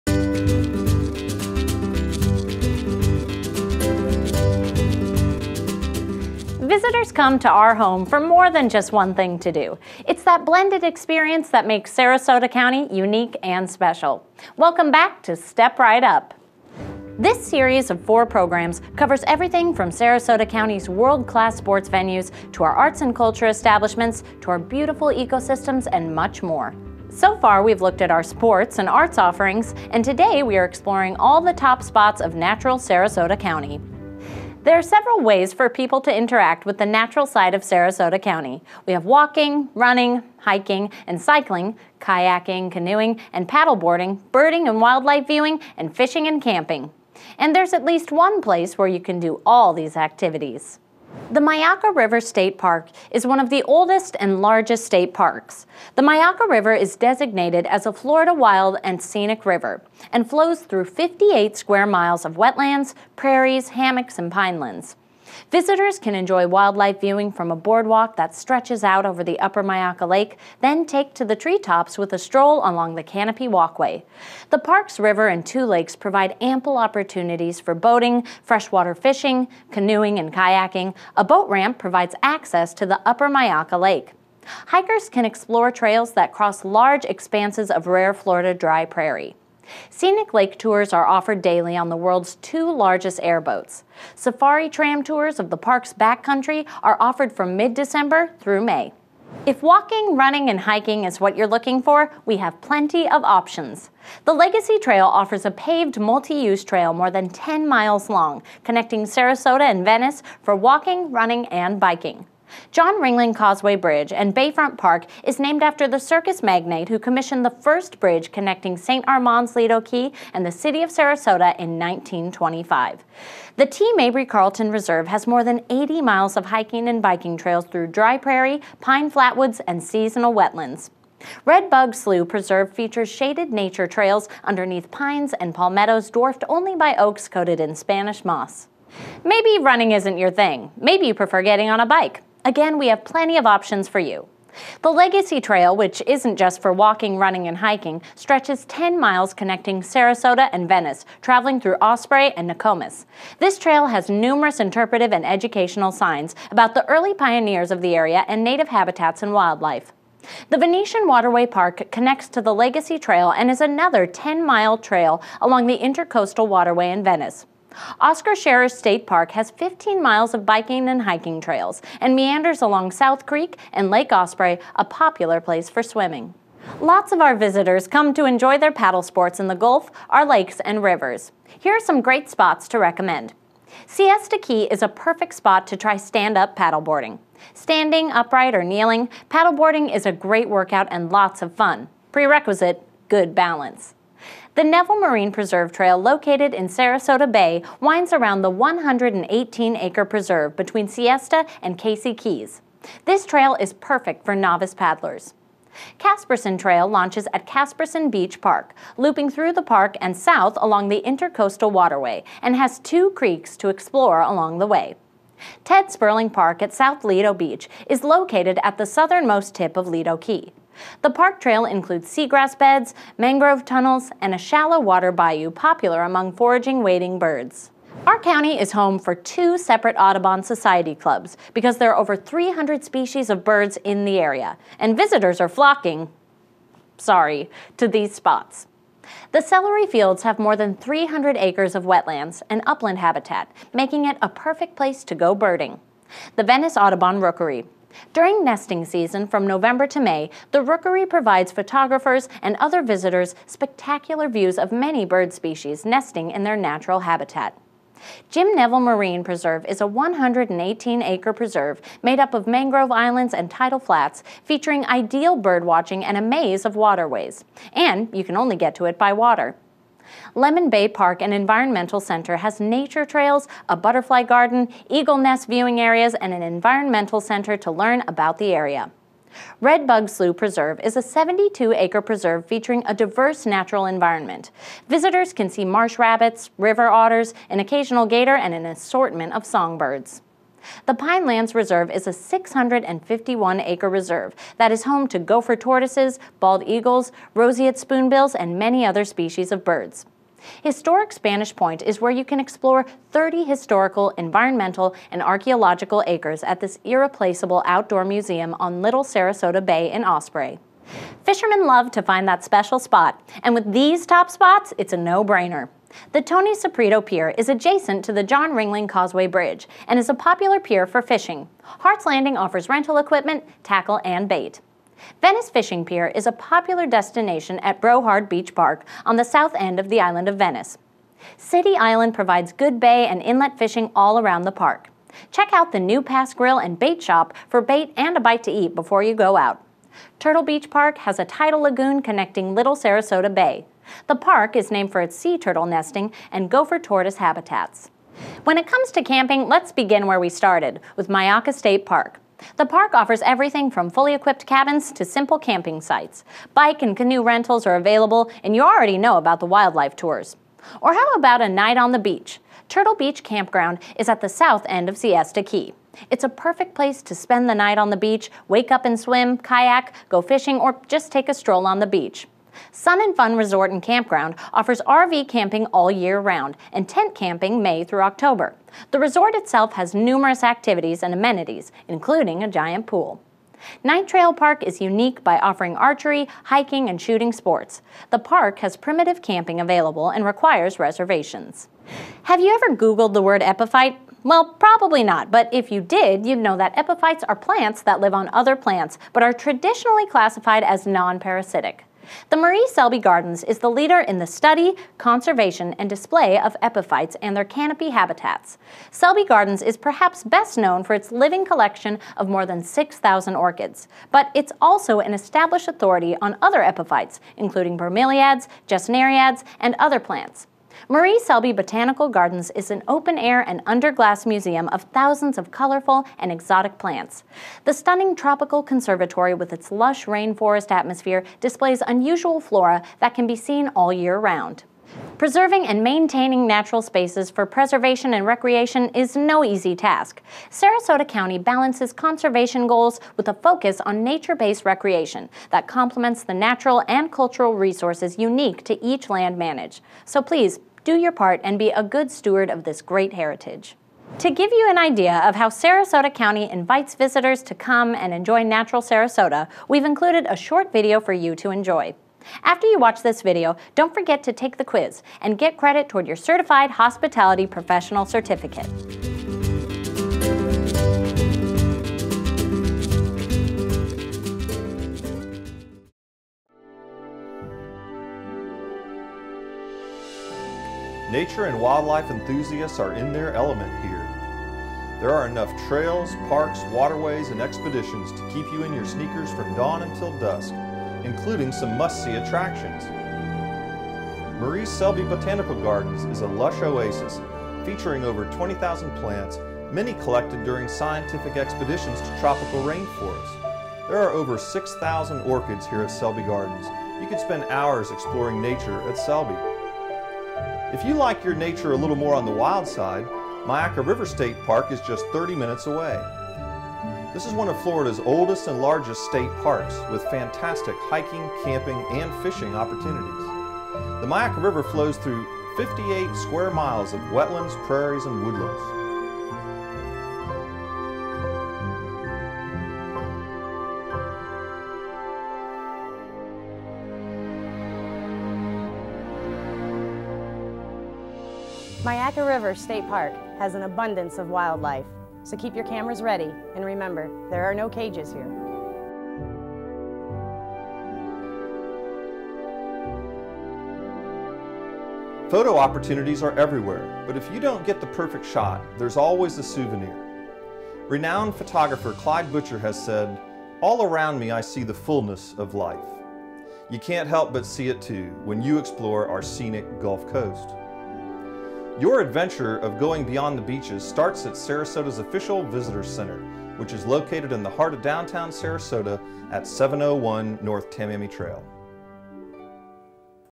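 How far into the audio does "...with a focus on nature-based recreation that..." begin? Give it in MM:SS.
07:23.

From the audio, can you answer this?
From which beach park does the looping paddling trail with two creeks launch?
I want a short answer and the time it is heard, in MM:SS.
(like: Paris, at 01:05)
Caspersen Beach Park, at 03:27.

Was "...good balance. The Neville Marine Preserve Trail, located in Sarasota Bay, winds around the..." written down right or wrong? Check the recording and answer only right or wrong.
right.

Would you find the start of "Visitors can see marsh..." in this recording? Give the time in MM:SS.
04:44.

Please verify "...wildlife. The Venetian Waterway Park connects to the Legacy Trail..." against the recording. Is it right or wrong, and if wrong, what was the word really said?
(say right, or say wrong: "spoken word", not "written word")
right.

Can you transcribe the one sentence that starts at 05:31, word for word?
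City Island provides good bay and inlet fishing all around the park.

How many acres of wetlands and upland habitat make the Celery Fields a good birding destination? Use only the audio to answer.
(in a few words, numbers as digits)
300.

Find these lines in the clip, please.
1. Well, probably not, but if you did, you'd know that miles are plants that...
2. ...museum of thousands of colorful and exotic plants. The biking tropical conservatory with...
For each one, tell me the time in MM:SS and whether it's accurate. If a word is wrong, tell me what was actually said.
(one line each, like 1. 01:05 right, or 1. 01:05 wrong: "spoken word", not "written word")
1. 06:34 wrong: "epiphytes", not "miles"
2. 07:04 wrong: "stunning", not "biking".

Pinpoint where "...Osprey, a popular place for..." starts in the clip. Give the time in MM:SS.
02:54.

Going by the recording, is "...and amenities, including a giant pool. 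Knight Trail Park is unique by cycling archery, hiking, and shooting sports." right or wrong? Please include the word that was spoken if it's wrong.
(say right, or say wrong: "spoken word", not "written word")
wrong: "offering", not "cycling".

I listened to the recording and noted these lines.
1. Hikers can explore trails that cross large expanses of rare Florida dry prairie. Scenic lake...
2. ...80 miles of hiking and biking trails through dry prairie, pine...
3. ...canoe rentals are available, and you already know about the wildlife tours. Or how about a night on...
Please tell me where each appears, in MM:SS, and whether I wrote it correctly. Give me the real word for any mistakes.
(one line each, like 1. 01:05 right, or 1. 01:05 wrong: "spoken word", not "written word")
1. 01:24 right
2. 02:05 right
3. 05:56 right.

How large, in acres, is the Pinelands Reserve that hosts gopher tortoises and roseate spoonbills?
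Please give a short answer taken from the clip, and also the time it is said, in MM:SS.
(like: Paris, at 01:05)
651, at 04:52.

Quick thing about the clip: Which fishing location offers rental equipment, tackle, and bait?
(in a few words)
Hart's Landing.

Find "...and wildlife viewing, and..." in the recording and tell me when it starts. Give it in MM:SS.
00:44.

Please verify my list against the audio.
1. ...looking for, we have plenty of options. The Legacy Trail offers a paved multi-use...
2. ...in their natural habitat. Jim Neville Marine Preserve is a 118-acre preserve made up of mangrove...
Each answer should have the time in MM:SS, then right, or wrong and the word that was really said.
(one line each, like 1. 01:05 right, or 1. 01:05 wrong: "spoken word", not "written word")
1. 01:41 right
2. 04:16 right.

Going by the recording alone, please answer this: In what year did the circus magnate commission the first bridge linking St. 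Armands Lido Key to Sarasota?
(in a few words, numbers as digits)
1925.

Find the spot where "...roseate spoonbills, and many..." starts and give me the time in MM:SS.
04:57.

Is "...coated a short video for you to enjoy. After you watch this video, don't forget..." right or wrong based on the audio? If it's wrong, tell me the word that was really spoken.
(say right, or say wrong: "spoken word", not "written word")
wrong: "included", not "coated".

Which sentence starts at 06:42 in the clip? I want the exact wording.
The Marie Selby Gardens is the leader in the study, conservation, and display of epiphytes and their canopy habitats.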